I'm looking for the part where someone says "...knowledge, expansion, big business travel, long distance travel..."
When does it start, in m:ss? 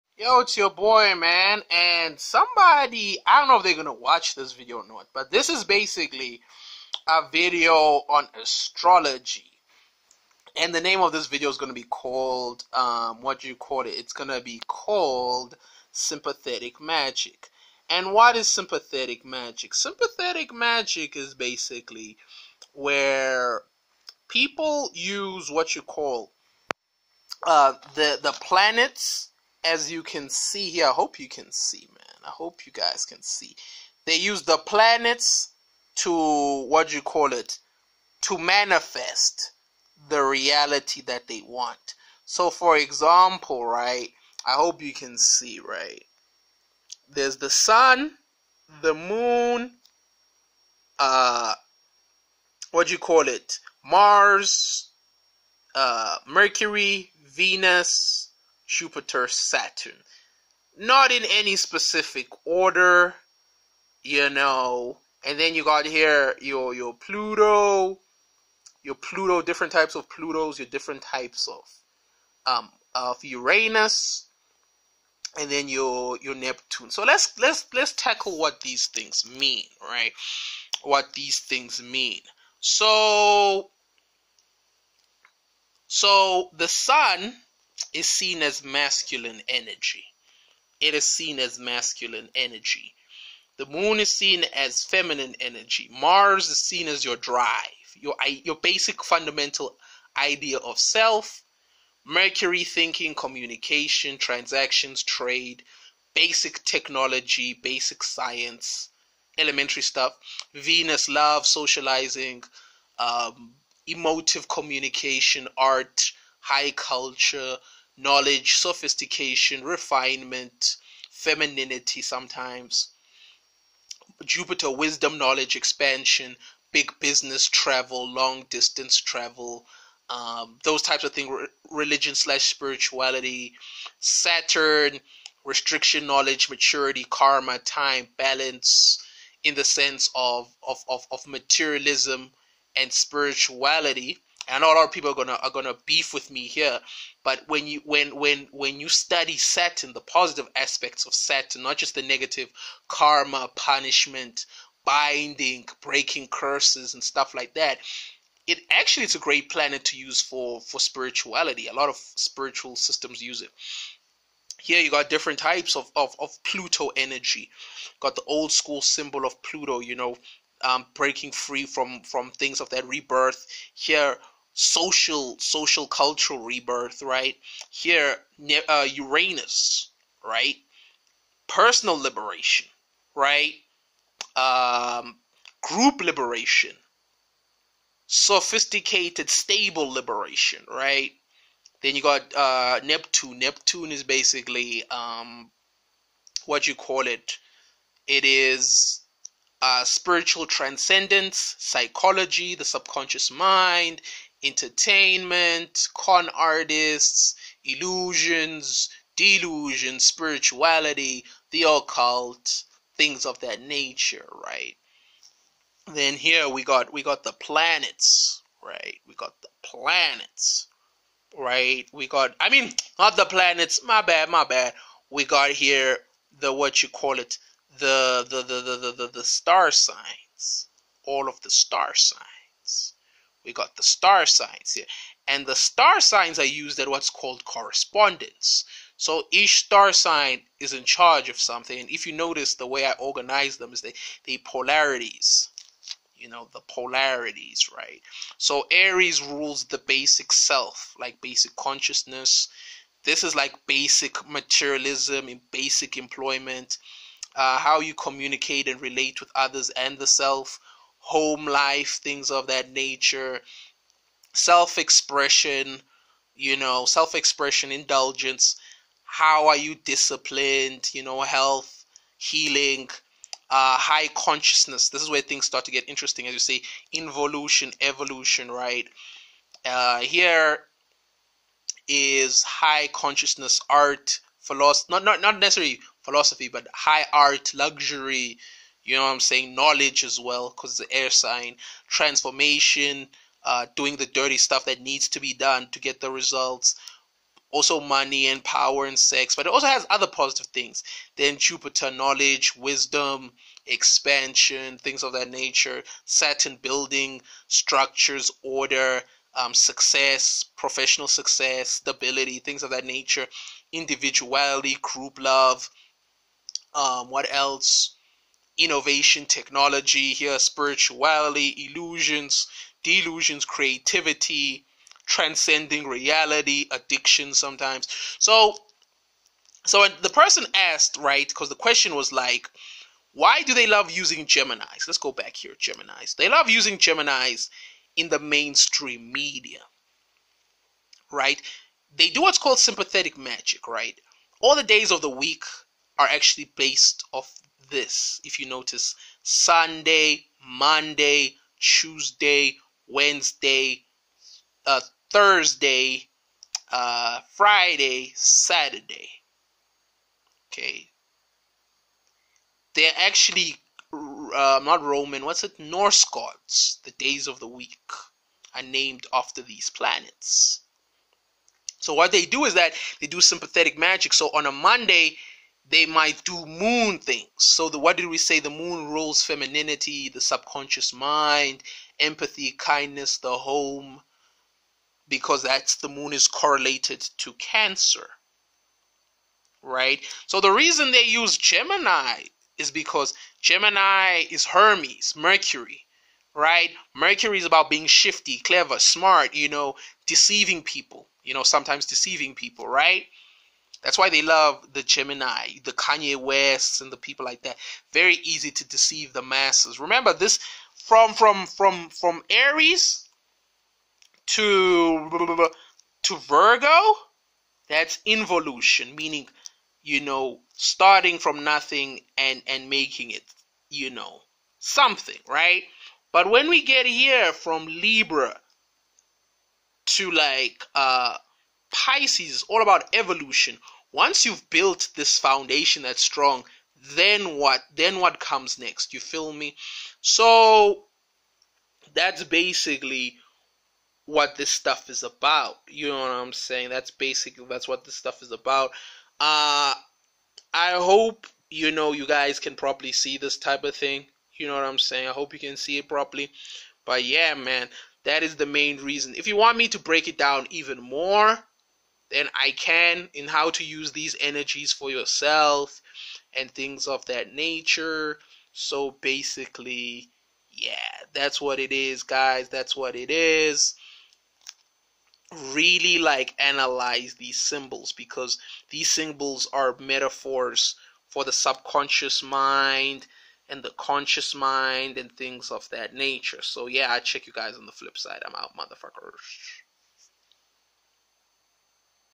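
2:05.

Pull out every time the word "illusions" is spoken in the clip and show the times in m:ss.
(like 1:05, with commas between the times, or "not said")
3:27, 5:21.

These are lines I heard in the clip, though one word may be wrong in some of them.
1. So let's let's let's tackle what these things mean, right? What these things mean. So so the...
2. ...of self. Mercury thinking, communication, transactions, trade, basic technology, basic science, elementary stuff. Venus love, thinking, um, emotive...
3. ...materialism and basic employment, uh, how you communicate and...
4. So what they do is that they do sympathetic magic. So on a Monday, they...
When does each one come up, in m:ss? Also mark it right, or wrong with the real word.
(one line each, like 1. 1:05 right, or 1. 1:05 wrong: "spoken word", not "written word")
1. 1:16 right
2. 1:40 wrong: "socializing", not "thinking"
3. 4:14 right
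4. 6:11 right.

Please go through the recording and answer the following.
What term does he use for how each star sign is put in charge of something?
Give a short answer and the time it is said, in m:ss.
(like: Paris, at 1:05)
correspondence, at 3:57.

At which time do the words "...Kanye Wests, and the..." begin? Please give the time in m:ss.
6:45.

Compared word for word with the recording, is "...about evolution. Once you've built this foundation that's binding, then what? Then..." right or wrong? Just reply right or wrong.
wrong.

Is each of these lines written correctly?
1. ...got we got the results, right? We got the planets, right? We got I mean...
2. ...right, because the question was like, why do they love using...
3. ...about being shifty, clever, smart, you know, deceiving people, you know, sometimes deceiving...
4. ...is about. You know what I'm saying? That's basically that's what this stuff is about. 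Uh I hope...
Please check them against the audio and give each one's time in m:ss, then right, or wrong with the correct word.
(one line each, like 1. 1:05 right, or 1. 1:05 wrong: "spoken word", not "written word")
1. 3:36 wrong: "planets", not "results"
2. 5:30 right
3. 6:37 right
4. 7:24 right.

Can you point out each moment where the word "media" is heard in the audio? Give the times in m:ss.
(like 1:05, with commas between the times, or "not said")
5:39.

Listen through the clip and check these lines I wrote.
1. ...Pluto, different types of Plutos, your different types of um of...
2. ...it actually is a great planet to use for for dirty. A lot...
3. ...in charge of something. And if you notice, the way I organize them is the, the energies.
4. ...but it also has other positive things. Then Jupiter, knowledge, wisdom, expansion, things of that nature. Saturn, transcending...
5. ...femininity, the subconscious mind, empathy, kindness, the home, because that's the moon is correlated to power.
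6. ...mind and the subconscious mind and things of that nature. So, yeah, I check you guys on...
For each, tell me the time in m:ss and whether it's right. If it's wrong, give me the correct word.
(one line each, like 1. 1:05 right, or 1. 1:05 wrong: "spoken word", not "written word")
1. 1:08 right
2. 2:38 wrong: "spirituality", not "dirty"
3. 4:00 wrong: "polarities", not "energies"
4. 4:59 wrong: "building", not "transcending"
5. 6:19 wrong: "cancer", not "power"
6. 8:02 wrong: "conscious", not "subconscious".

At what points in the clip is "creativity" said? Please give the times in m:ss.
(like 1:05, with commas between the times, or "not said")
5:23.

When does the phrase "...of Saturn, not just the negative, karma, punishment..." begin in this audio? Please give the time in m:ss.
2:31.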